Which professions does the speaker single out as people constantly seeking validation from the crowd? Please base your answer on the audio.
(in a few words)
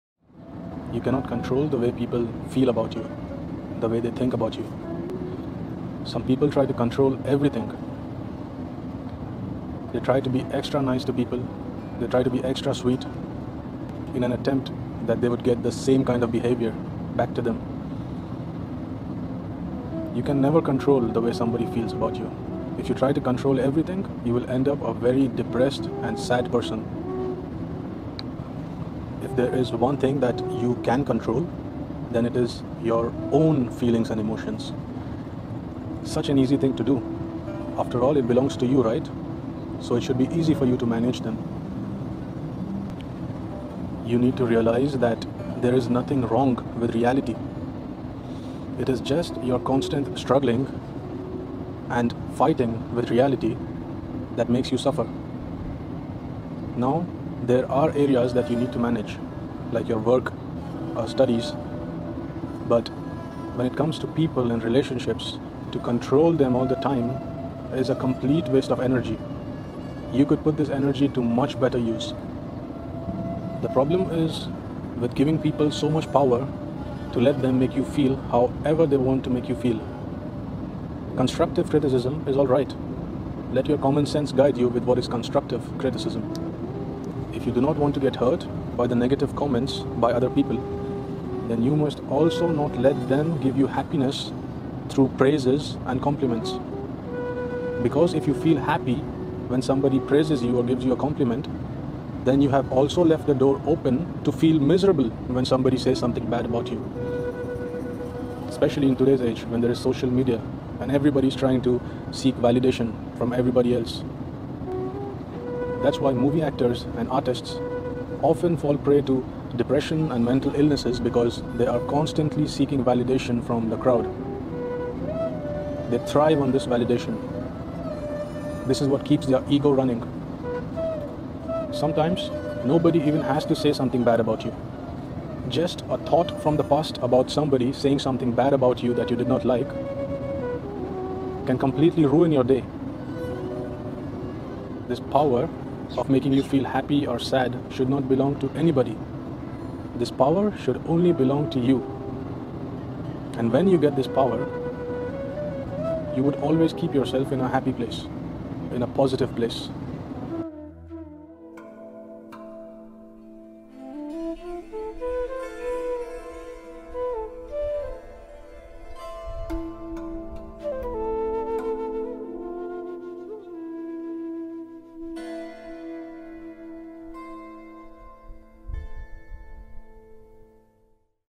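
movie actors and artists.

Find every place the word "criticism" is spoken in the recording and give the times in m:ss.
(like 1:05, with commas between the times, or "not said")
1:21, 1:25.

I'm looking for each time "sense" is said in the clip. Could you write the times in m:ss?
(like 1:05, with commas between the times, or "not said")
1:24.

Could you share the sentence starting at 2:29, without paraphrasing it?
This power should only belong to you.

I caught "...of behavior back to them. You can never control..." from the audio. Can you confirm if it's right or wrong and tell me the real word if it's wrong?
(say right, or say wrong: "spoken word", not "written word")
right.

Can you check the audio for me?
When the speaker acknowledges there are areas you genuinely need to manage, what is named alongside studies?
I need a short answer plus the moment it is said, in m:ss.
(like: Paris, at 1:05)
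work, at 0:59.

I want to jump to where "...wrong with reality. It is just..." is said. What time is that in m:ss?
0:46.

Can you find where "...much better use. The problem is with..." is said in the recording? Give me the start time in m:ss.
1:11.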